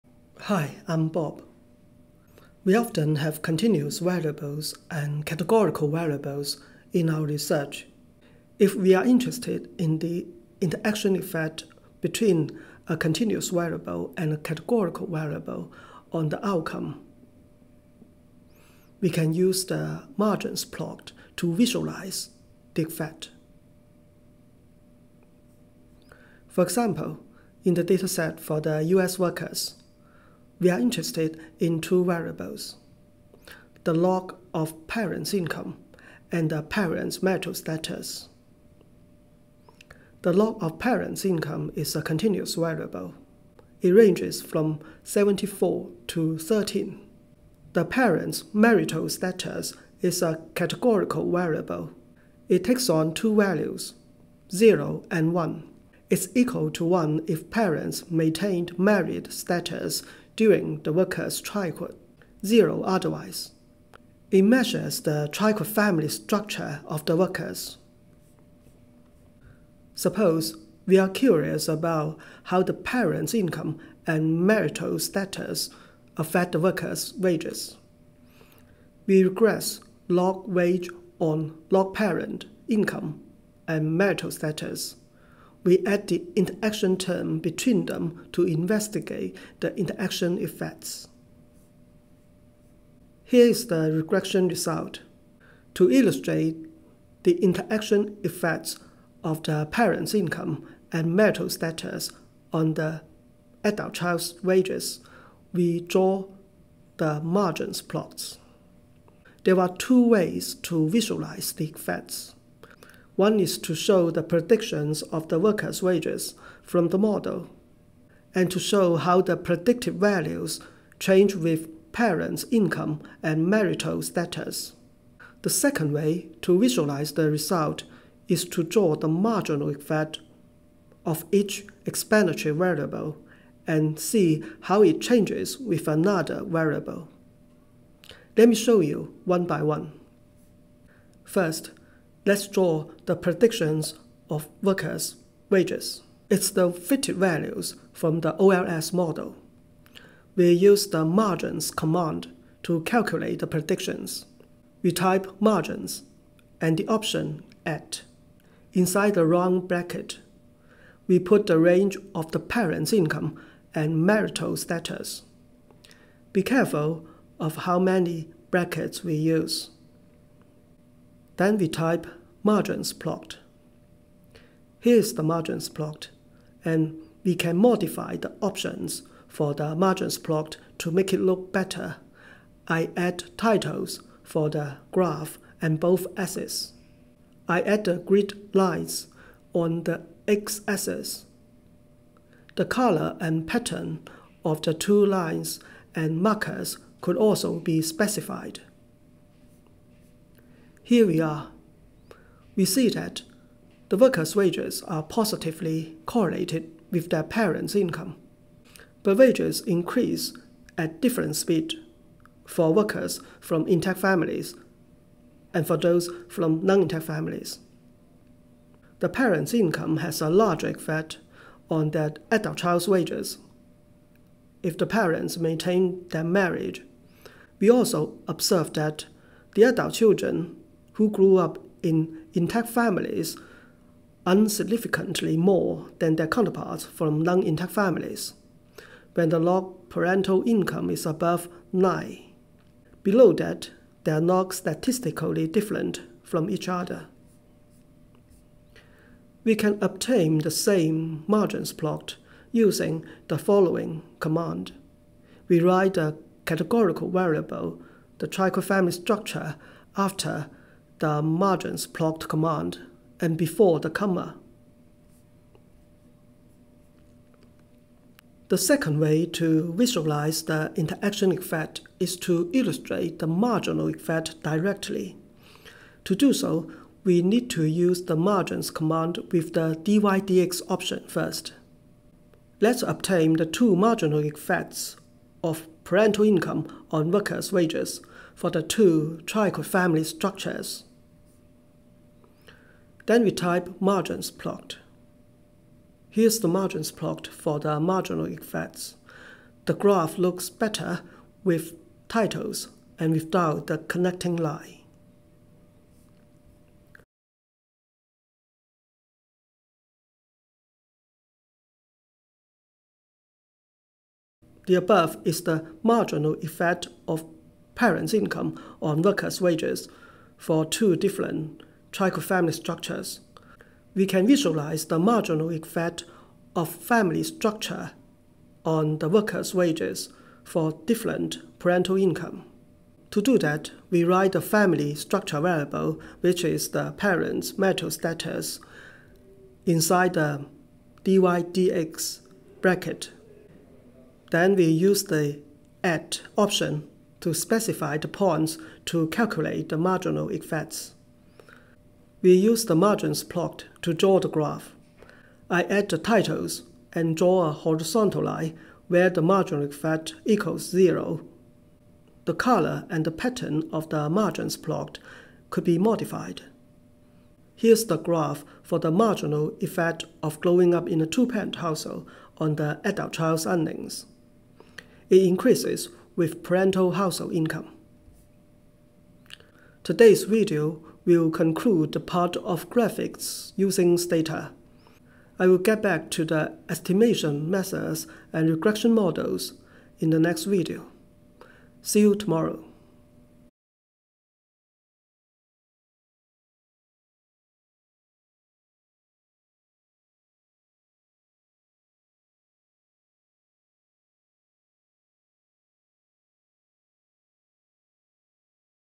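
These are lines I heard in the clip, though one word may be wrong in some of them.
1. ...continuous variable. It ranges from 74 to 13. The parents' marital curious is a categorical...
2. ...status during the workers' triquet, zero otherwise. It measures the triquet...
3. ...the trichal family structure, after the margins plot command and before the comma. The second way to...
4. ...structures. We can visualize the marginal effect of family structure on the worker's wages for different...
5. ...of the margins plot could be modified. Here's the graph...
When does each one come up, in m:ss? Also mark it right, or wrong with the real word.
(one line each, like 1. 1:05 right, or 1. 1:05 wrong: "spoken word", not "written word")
1. 0:42 wrong: "status", not "curious"
2. 0:59 right
3. 4:18 right
4. 5:22 right
5. 6:03 right.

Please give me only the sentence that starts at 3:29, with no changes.
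But wages increase at different speed for workers from intact families and for those from non-intact families.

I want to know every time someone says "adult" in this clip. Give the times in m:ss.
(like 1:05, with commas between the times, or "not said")
1:43, 3:42, 3:49, 6:12.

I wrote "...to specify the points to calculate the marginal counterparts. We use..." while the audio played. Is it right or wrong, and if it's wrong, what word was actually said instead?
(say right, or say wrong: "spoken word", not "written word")
wrong: "effects", not "counterparts".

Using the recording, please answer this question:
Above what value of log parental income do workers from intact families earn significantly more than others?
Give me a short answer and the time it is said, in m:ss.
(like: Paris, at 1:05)
9, at 4:01.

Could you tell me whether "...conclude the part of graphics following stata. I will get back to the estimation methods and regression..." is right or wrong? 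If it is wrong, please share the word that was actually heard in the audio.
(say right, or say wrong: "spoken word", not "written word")
wrong: "using", not "following".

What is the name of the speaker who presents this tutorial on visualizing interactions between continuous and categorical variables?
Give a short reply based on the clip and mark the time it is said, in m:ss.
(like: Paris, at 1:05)
Bob, at 0:01.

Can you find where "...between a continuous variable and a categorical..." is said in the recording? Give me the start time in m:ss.
0:12.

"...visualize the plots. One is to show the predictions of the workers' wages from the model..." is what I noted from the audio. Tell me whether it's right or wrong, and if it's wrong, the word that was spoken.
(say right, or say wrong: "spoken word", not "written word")
wrong: "effects", not "plots".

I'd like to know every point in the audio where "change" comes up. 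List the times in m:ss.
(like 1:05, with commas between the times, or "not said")
2:00, 2:14.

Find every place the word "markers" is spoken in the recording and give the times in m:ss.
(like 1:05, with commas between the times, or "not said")
3:16.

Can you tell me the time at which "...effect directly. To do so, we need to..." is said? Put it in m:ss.
4:33.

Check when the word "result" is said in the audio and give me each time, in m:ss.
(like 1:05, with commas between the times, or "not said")
1:34, 2:07.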